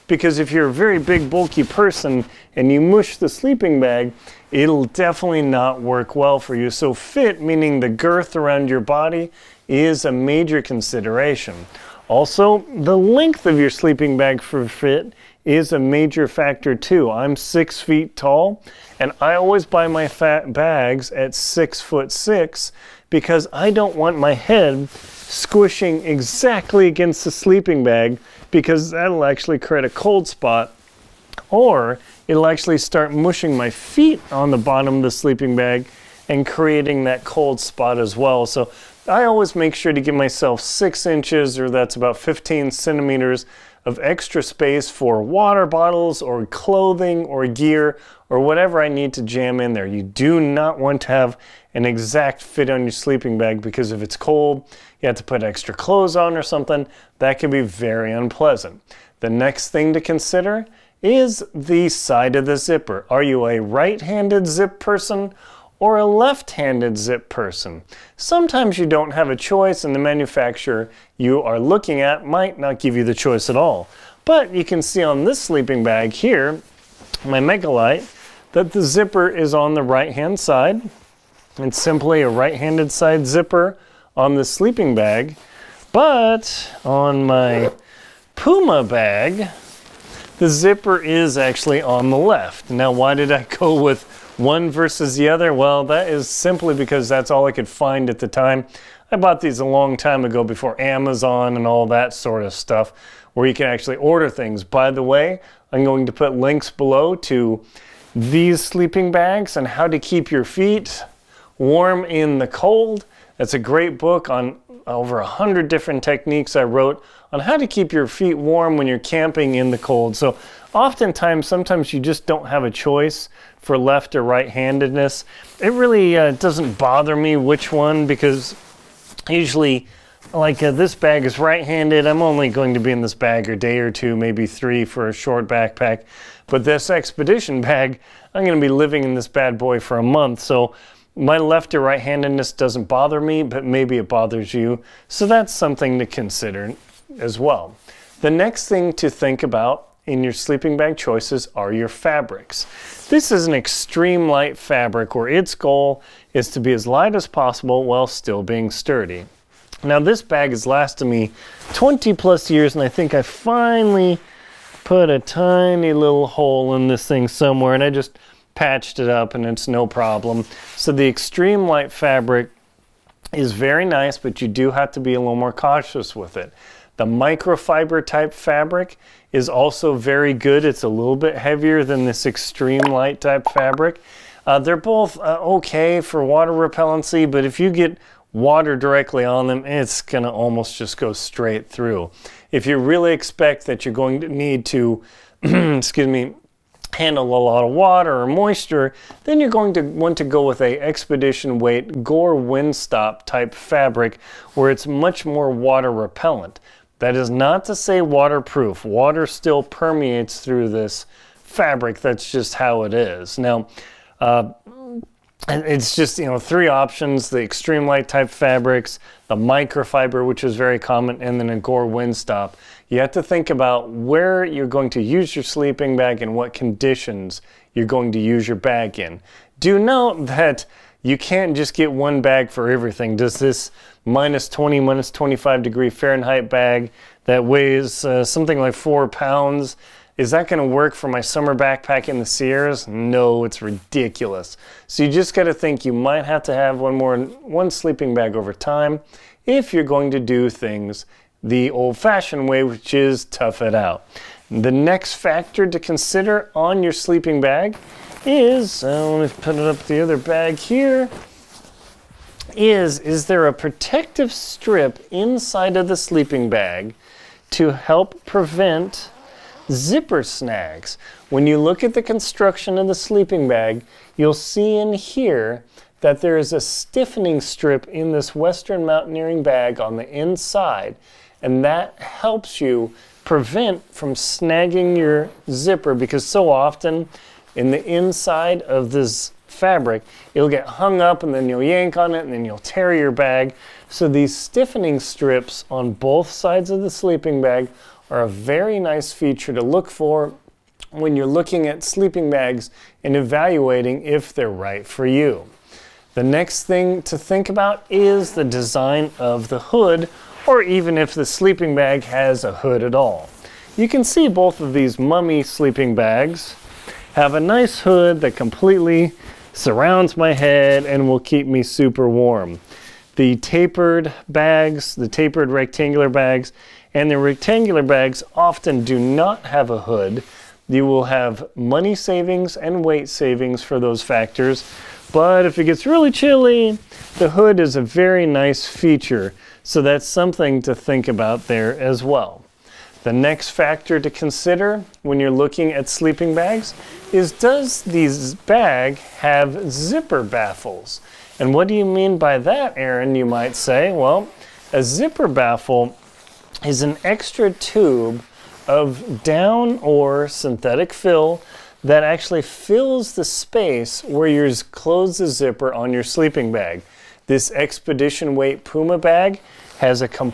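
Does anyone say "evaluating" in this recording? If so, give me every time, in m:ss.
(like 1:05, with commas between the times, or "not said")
5:03.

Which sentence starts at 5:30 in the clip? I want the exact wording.
You will have money savings and weight savings for those factors.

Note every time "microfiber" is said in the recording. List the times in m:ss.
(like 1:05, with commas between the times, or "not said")
2:57, 3:39.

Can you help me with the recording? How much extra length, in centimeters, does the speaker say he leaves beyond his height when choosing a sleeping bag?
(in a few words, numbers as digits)
15.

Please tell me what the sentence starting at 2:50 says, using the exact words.
So the extreme light fabric is very nice, but you do have to be a little more cautious with it.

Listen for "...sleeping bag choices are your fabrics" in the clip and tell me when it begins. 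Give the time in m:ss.
2:30.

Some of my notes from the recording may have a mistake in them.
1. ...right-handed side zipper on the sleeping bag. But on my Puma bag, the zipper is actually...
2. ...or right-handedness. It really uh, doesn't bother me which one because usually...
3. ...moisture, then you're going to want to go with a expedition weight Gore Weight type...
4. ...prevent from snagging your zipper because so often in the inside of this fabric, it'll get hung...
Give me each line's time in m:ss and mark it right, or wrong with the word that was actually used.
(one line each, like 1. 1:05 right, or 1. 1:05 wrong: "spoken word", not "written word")
1. 1:22 right
2. 2:04 right
3. 3:18 wrong: "Windstop", not "Weight"
4. 4:43 right.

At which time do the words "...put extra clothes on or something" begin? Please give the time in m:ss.
0:55.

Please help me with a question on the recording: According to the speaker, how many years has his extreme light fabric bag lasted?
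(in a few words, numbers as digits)
20 plus years.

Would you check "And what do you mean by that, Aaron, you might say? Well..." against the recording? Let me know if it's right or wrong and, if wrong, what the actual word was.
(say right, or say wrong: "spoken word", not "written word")
right.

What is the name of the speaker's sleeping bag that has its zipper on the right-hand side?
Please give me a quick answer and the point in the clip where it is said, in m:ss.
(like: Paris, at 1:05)
Megalite, at 1:17.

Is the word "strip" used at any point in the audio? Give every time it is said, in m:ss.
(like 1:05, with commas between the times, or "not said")
4:24, 4:37, 4:54.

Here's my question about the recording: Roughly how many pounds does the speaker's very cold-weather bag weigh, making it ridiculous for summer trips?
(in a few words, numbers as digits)
4.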